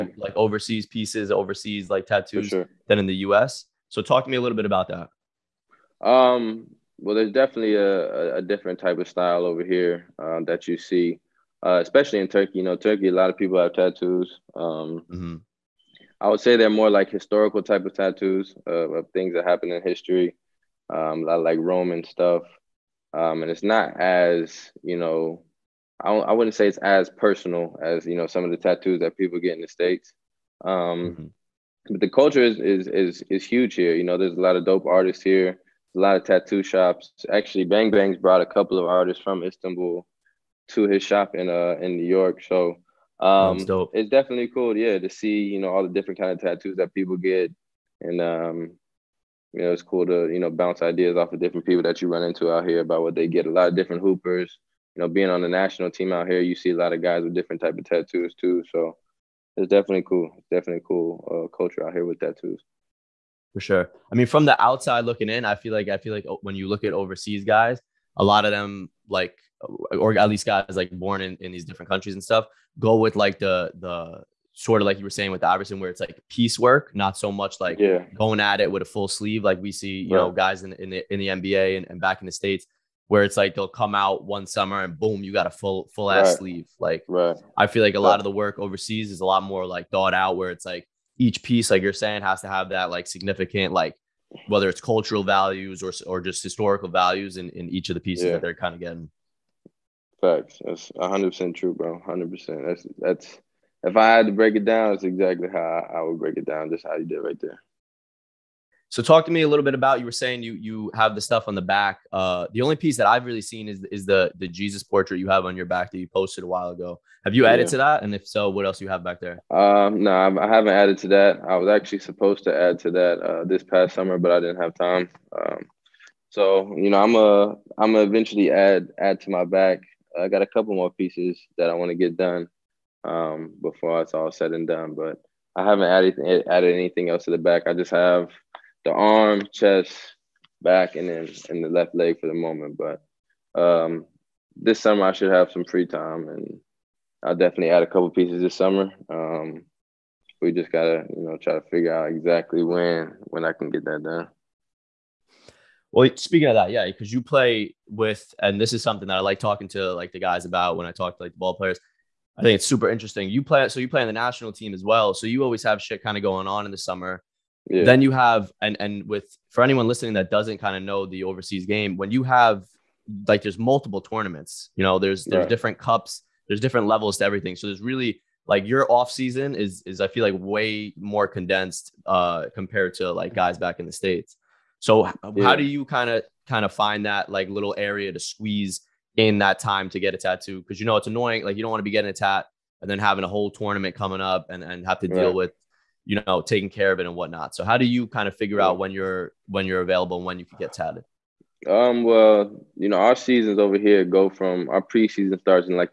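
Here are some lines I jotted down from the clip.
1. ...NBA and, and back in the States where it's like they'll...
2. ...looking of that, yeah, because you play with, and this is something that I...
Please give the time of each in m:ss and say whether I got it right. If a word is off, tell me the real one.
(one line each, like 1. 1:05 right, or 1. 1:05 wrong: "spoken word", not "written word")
1. 1:21 right
2. 2:36 wrong: "speaking", not "looking".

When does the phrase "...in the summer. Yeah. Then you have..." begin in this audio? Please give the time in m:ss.
2:46.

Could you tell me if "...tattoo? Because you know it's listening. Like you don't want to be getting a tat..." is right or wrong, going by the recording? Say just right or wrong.
wrong.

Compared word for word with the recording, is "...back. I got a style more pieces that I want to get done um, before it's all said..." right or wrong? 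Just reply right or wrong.
wrong.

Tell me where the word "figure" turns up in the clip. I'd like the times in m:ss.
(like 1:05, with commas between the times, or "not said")
2:31, 3:18.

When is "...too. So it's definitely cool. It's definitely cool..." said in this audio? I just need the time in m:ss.
0:58.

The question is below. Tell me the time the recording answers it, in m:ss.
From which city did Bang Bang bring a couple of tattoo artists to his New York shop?
0:39.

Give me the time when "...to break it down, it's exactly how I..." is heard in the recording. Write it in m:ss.
1:44.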